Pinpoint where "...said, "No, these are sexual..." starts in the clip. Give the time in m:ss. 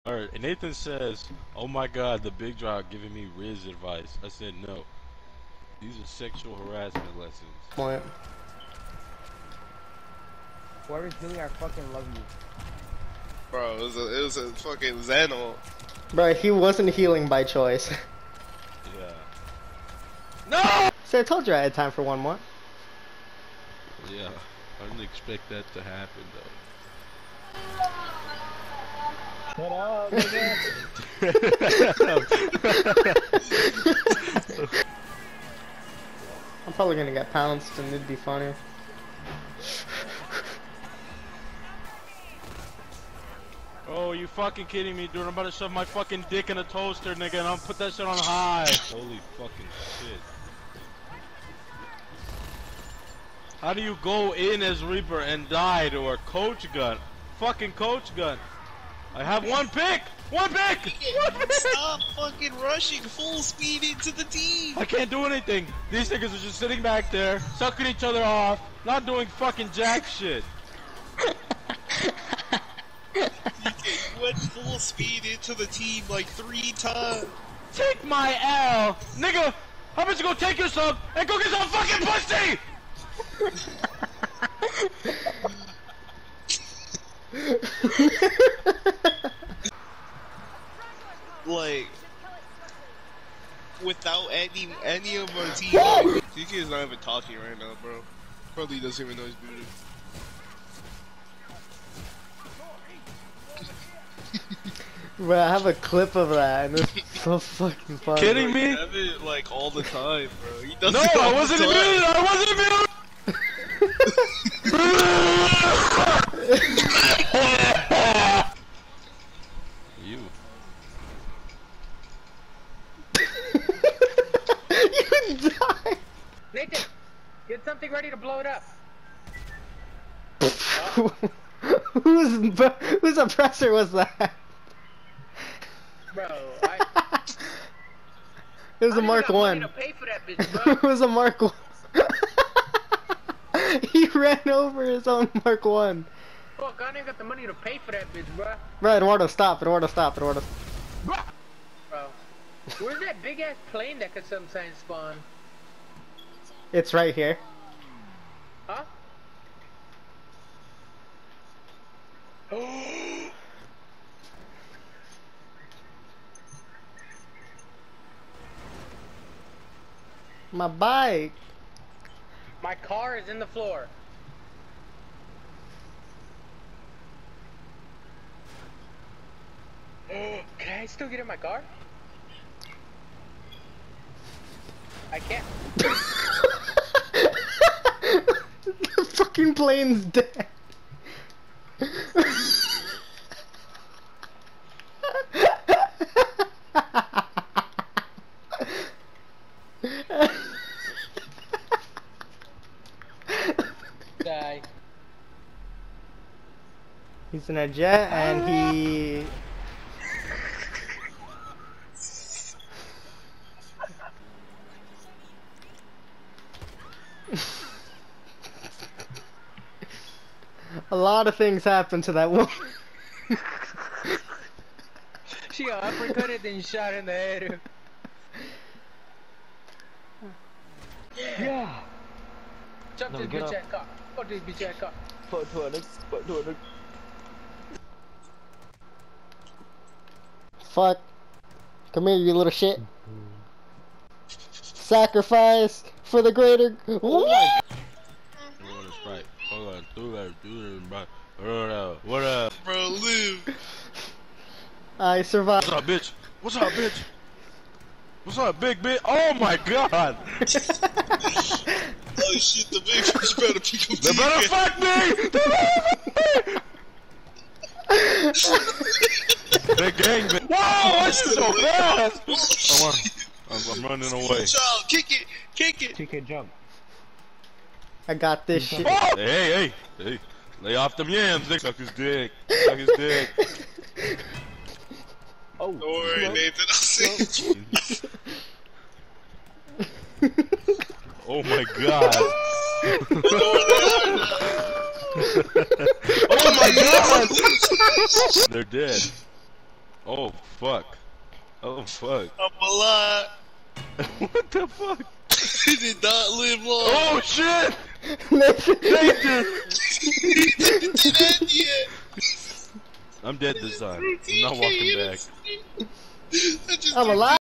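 0:04.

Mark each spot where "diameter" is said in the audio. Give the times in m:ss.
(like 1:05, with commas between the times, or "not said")
not said.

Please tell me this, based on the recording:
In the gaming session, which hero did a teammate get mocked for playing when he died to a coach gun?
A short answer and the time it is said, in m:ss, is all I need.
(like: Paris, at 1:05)
Reaper, at 0:54.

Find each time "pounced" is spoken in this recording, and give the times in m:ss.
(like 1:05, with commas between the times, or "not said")
0:37.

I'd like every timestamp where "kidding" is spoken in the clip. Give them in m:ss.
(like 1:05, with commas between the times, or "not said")
0:44, 1:48.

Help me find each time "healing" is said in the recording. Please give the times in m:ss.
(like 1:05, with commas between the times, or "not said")
0:16.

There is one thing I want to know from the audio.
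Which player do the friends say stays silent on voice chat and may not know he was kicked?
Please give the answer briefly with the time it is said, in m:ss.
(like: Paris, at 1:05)
DK, at 1:36.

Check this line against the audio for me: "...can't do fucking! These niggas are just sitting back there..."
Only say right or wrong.
wrong.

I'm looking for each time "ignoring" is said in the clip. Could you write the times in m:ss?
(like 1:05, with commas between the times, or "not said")
not said.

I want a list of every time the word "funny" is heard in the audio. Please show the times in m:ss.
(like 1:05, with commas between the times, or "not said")
0:38, 1:47.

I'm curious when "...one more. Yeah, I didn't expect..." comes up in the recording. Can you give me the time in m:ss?
0:22.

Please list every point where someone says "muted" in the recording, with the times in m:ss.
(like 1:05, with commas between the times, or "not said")
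1:51, 1:56.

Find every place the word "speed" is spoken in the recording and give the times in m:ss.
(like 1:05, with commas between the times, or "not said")
1:03, 1:14.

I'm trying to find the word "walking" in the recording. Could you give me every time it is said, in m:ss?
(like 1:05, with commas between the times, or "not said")
5:14.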